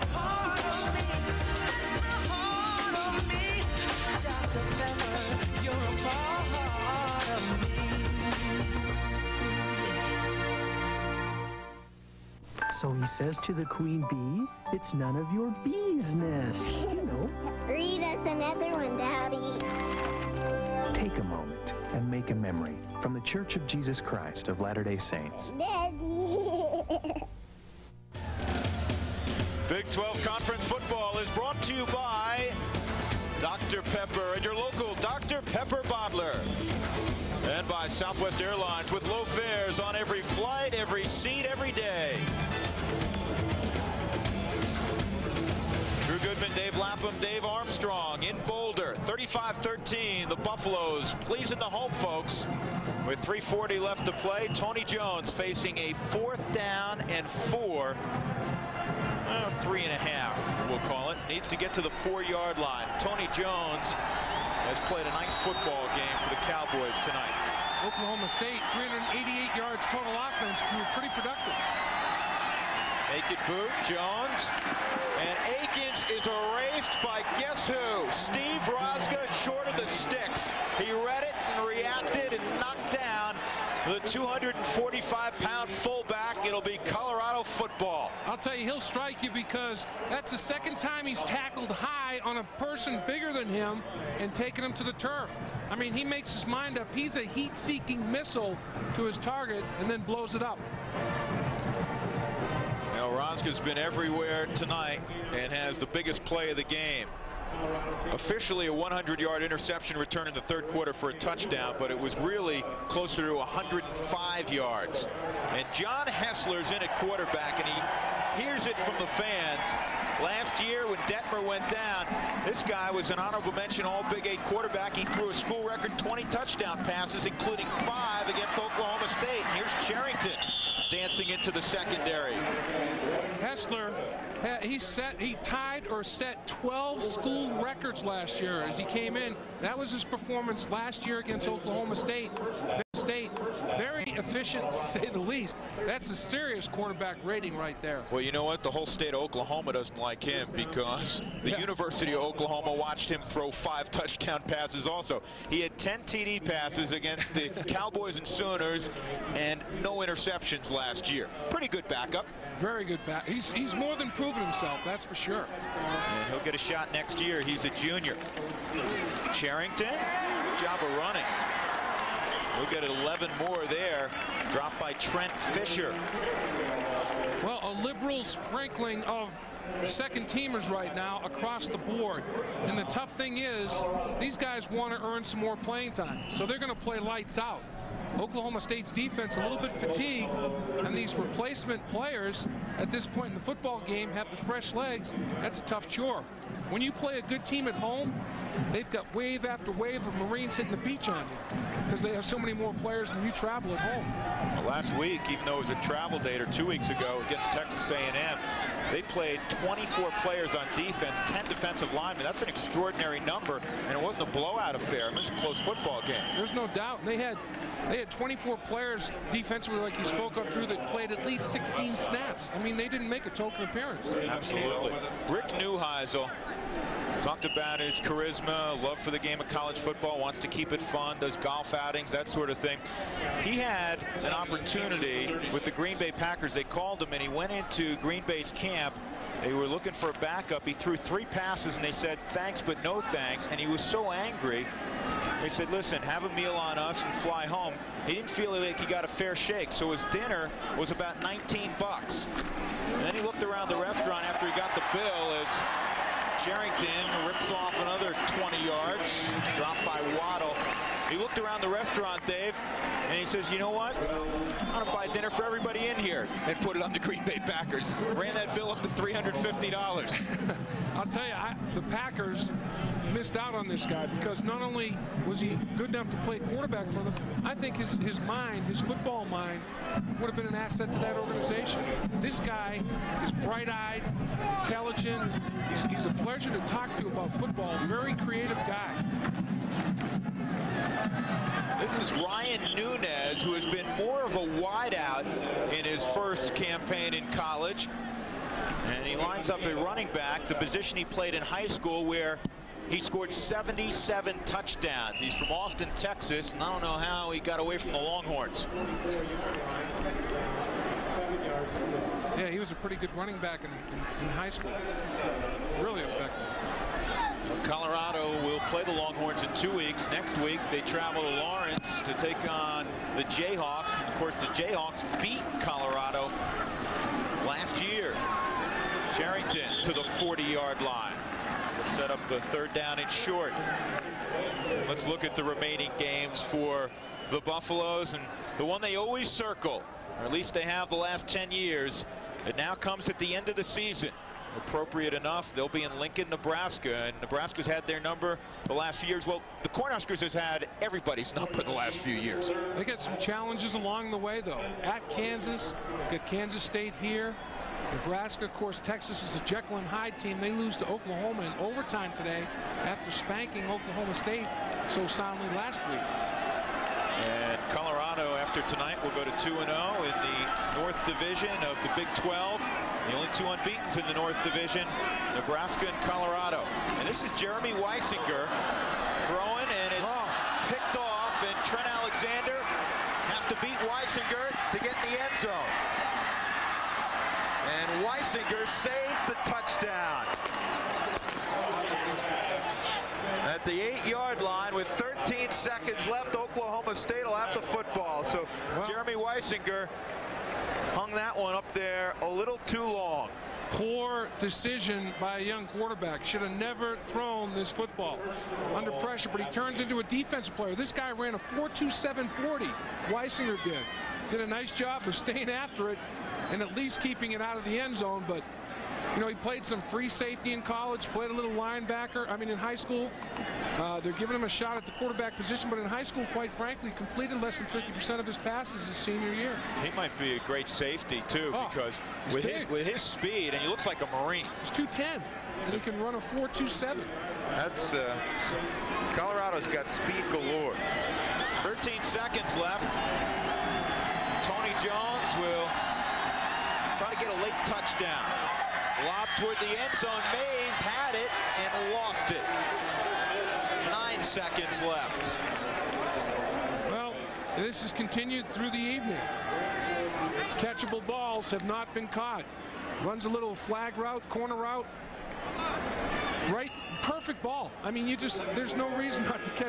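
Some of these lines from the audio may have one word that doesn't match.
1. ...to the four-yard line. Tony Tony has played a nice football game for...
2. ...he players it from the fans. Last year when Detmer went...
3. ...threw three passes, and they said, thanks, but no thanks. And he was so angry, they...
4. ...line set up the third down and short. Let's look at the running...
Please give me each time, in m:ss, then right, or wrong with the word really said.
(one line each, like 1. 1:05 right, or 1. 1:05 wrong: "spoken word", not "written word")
1. 1:01 wrong: "Jones", not "Tony"
2. 1:57 wrong: "hears", not "players"
3. 4:00 right
4. 5:30 wrong: "remaining", not "running".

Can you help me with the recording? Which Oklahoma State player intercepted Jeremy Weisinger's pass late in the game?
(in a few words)
Trent Alexander.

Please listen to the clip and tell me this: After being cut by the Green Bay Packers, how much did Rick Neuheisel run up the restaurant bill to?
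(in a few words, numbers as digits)
$350.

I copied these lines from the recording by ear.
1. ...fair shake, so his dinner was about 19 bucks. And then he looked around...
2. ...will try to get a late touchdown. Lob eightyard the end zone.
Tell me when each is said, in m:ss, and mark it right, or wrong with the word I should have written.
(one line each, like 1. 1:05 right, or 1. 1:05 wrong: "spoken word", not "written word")
1. 4:09 right
2. 7:25 wrong: "toward", not "eightyard".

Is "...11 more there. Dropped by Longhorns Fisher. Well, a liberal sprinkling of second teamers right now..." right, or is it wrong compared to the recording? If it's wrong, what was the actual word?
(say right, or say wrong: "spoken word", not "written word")
wrong: "Trent", not "Longhorns".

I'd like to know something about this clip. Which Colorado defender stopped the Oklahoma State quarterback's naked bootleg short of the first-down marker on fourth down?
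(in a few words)
Steve Rosga.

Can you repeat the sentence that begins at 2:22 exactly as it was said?
State, very efficient, to say the least.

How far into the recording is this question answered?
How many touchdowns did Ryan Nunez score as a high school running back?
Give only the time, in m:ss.
5:03.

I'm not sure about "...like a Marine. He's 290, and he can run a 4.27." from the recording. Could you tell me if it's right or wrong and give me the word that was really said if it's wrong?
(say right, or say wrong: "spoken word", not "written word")
wrong: "210", not "290".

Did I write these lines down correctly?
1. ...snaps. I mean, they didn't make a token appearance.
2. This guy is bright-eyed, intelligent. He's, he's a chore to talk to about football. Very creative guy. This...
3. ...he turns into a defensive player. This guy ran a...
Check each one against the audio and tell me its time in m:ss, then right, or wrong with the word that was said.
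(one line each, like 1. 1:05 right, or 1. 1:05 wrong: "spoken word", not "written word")
1. 3:41 right
2. 4:42 wrong: "pleasure", not "chore"
3. 6:49 right.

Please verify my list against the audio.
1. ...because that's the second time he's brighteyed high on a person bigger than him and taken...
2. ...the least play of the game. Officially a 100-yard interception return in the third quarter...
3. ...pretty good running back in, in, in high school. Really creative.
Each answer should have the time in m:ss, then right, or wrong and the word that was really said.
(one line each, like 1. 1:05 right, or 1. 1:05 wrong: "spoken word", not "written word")
1. 1:29 wrong: "tackled", not "brighteyed"
2. 1:45 wrong: "biggest", not "least"
3. 5:12 wrong: "effective", not "creative".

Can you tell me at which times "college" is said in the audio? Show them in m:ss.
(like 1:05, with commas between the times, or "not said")
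3:49, 4:57, 7:00.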